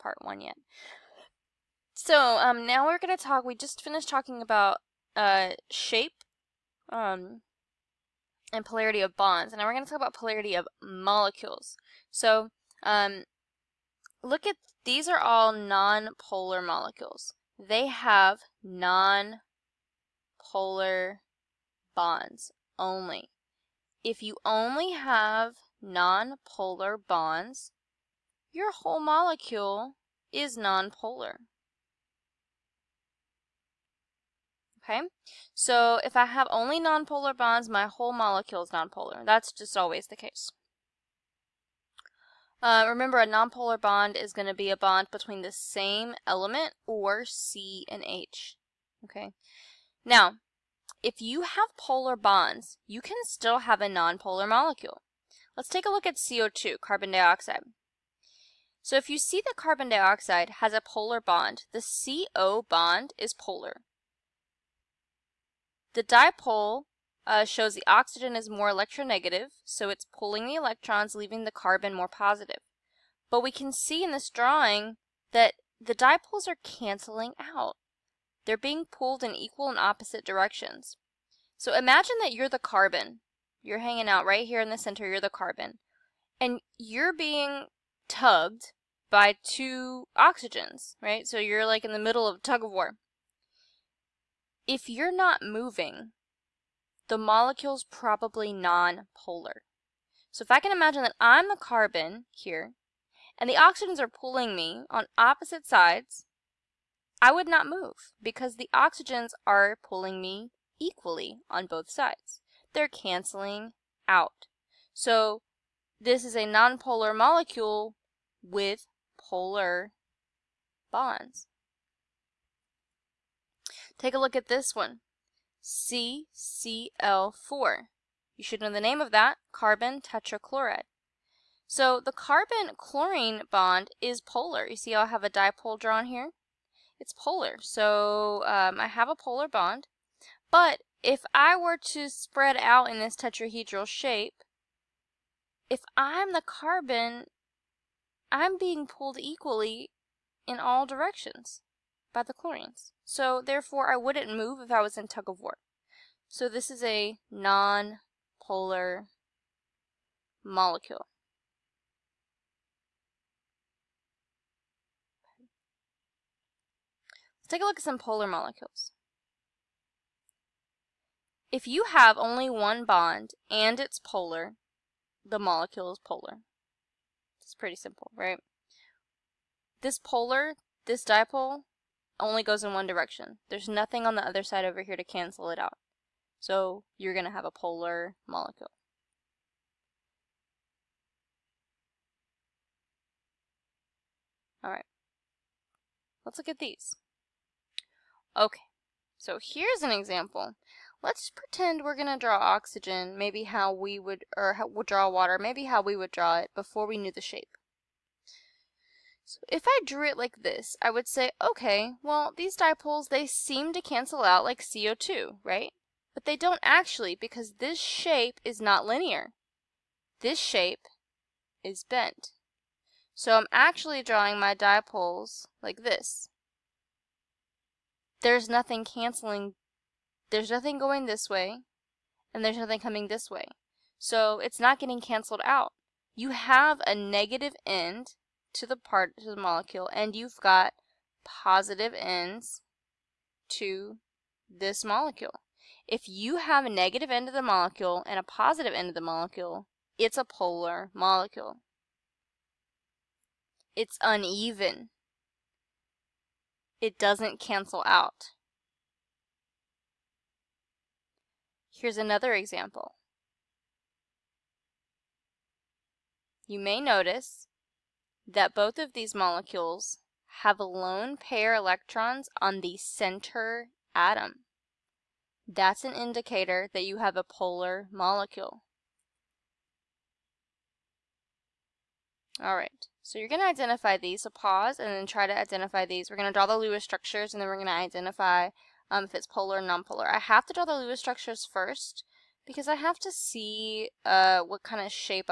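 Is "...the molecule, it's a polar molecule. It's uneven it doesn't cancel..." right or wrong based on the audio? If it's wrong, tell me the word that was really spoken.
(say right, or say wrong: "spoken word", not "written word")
right.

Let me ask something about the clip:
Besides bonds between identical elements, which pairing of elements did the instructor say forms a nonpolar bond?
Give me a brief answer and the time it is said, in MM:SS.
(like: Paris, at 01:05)
C and H, at 00:47.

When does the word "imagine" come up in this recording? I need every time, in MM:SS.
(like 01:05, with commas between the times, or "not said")
01:21, 01:40.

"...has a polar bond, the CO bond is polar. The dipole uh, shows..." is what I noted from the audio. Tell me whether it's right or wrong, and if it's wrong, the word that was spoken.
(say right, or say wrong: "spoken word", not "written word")
right.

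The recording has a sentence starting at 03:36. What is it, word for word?
But they don't actually because this shape is not linear.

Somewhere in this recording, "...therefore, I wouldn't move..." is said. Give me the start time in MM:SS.
02:33.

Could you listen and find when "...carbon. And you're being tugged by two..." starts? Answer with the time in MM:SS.
01:25.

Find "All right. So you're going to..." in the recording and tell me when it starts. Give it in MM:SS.
04:42.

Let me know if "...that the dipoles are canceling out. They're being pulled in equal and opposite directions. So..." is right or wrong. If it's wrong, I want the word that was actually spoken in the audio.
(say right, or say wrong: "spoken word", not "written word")
right.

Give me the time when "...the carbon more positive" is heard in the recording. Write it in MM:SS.
01:11.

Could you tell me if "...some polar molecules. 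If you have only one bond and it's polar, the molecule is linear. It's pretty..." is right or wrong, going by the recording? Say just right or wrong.
wrong.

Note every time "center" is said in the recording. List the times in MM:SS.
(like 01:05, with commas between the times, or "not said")
01:24, 04:32.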